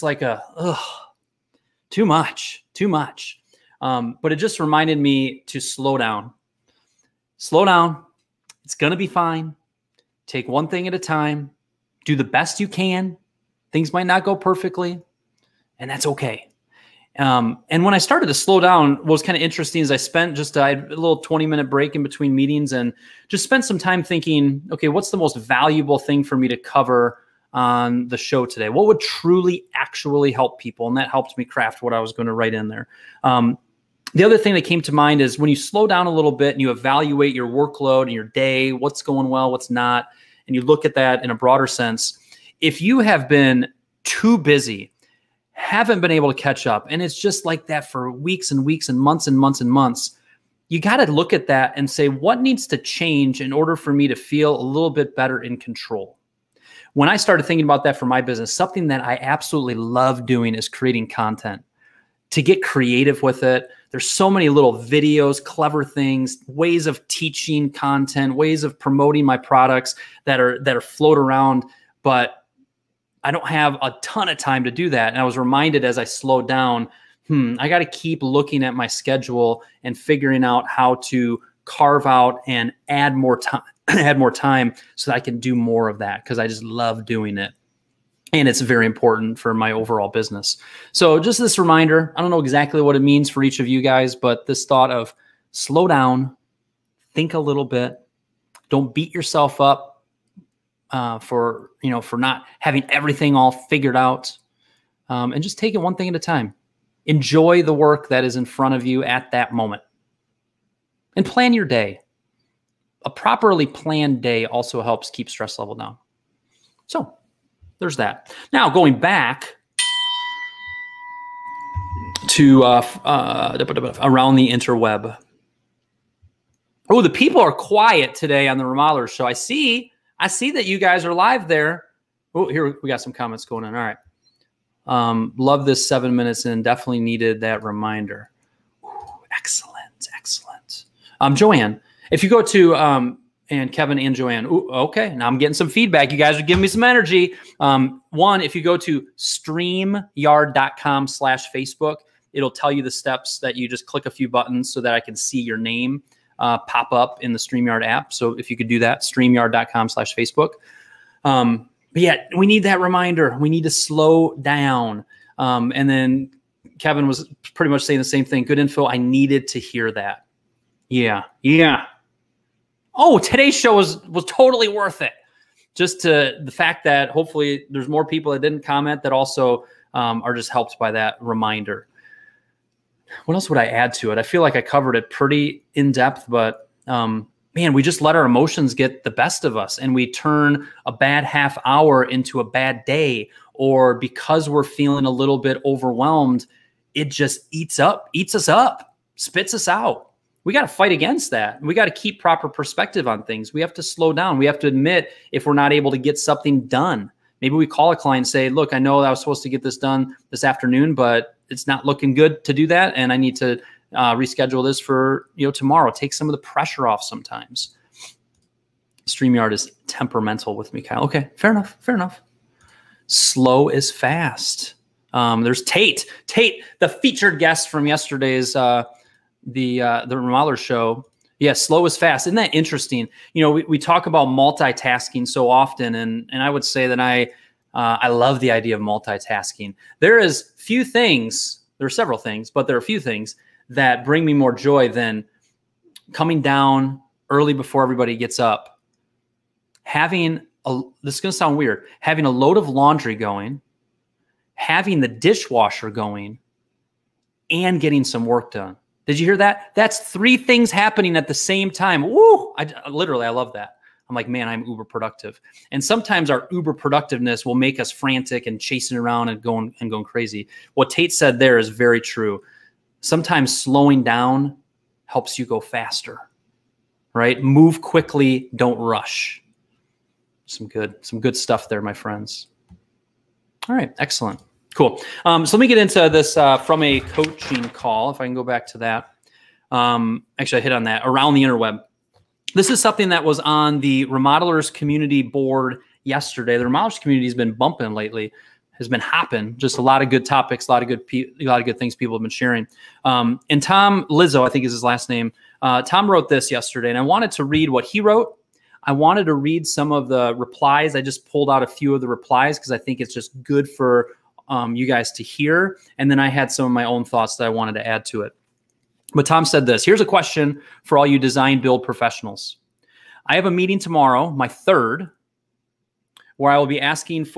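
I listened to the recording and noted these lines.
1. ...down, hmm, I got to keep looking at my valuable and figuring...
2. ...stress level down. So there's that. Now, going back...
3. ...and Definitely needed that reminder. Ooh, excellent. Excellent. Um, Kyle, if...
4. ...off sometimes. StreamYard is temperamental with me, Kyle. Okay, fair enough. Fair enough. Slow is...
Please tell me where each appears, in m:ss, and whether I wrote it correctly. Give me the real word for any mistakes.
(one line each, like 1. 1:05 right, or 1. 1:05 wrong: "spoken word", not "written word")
1. 1:16 wrong: "schedule", not "valuable"
2. 1:55 right
3. 2:16 wrong: "Joanne", not "Kyle"
4. 3:36 right.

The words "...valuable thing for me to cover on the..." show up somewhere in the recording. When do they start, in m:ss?
0:25.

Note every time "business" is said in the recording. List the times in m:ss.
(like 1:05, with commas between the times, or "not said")
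0:58, 1:30.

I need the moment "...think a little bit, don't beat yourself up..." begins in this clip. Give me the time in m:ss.
1:37.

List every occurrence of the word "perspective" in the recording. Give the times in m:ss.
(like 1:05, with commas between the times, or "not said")
3:22.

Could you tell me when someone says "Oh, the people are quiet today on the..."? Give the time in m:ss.
2:06.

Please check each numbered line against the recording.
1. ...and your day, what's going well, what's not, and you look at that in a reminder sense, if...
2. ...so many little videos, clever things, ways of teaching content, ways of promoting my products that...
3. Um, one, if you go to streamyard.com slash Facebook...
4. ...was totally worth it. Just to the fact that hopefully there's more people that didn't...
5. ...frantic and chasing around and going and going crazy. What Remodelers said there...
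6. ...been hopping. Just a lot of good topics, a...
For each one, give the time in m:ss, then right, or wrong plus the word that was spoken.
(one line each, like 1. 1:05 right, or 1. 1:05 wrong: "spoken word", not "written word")
1. 0:38 wrong: "broader", not "reminder"
2. 1:04 right
3. 2:27 right
4. 2:54 right
5. 4:27 wrong: "Tate", not "Remodelers"
6. 4:58 right.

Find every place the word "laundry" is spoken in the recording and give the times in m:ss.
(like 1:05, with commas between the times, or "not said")
4:12.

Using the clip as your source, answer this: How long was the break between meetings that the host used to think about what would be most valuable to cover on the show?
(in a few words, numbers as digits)
20 minutes.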